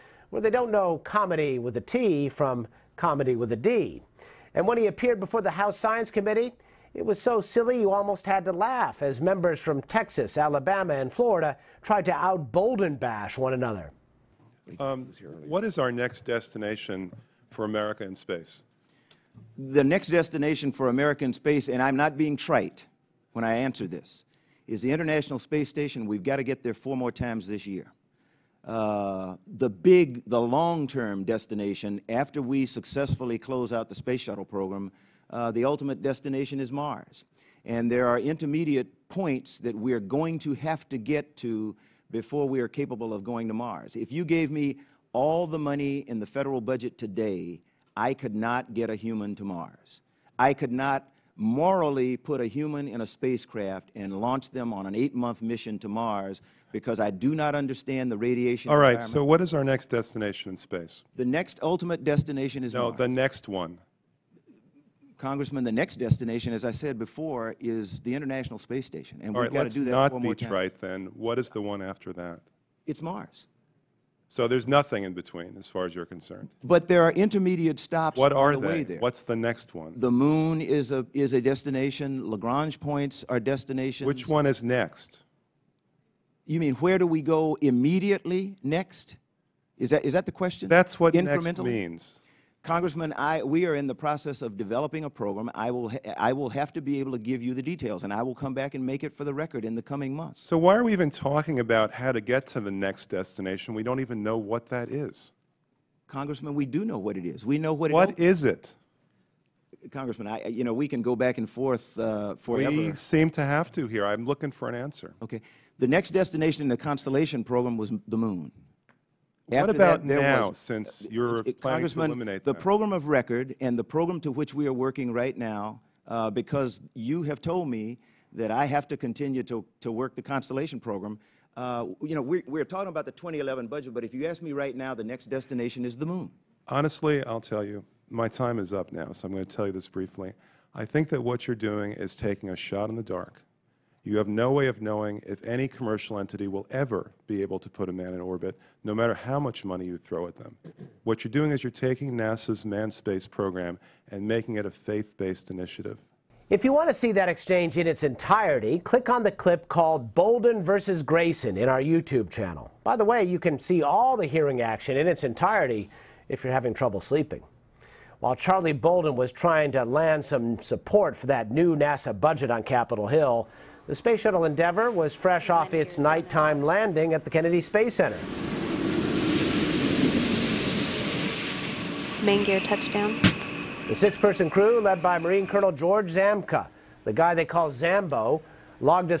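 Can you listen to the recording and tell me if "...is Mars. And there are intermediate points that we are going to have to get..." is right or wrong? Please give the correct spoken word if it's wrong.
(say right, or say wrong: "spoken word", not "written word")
right.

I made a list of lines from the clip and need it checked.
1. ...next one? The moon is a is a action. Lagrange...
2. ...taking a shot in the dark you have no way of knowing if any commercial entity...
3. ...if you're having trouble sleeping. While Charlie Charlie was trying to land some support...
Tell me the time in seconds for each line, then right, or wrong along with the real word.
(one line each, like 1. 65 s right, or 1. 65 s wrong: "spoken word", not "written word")
1. 79 s wrong: "destination", not "action"
2. 142 s right
3. 166 s wrong: "Bolden", not "Charlie".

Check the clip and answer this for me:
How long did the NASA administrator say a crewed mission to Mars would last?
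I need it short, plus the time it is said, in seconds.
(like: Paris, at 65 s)
8 months, at 54 s.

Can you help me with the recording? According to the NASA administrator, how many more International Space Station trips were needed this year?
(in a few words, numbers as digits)
4.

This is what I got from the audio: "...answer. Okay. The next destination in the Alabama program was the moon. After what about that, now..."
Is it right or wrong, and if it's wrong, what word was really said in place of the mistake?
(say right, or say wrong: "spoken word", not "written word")
wrong: "Constellation", not "Alabama".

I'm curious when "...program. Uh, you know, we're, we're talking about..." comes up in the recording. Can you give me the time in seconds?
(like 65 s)
130 s.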